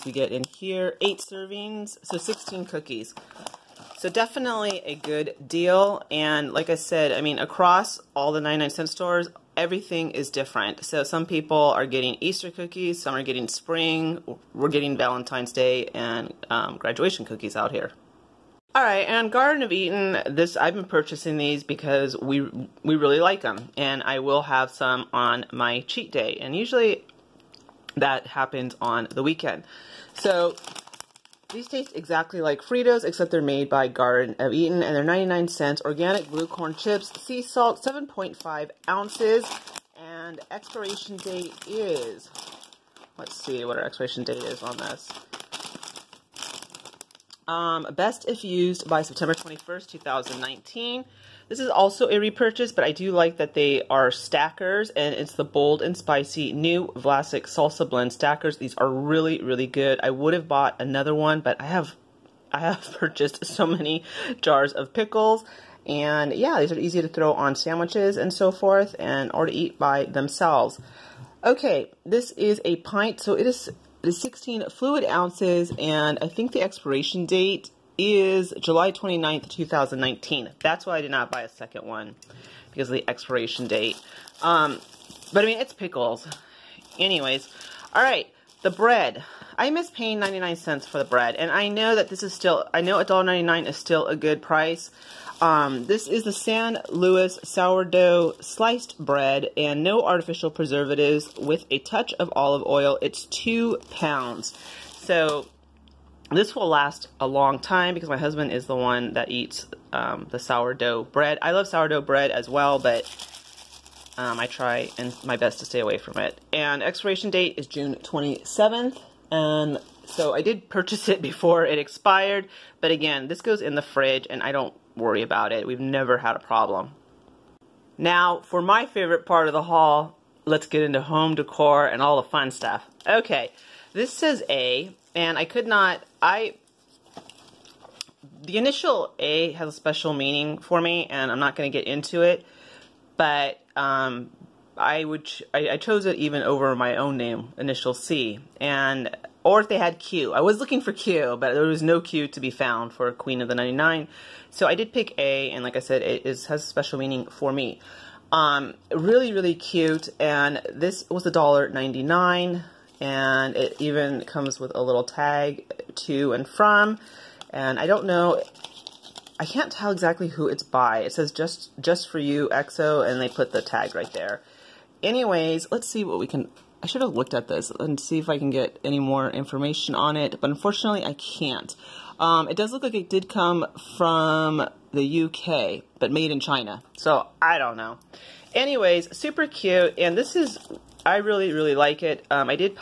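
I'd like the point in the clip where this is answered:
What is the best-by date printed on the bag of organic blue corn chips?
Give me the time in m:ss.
0:49.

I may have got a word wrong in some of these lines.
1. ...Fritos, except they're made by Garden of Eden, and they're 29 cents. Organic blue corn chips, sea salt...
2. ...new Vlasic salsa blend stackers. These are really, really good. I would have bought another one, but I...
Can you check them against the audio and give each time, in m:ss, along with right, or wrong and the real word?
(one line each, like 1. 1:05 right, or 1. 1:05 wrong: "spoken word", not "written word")
1. 0:32 wrong: "99", not "29"
2. 0:56 right.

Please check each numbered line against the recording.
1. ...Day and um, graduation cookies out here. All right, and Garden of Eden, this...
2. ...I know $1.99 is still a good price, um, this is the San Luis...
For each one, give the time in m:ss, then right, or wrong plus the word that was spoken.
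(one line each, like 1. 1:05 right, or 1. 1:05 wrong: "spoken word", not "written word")
1. 0:15 right
2. 1:32 right.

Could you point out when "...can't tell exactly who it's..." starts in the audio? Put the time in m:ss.
2:49.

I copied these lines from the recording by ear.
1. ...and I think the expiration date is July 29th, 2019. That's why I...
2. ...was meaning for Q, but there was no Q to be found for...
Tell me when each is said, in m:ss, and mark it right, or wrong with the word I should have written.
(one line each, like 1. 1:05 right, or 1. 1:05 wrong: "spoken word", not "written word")
1. 1:15 right
2. 2:30 wrong: "looking", not "meaning".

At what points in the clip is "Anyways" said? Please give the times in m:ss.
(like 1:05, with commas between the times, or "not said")
1:26, 2:55, 3:08.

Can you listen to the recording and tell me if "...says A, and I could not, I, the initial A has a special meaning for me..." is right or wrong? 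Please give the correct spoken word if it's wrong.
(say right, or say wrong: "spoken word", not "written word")
right.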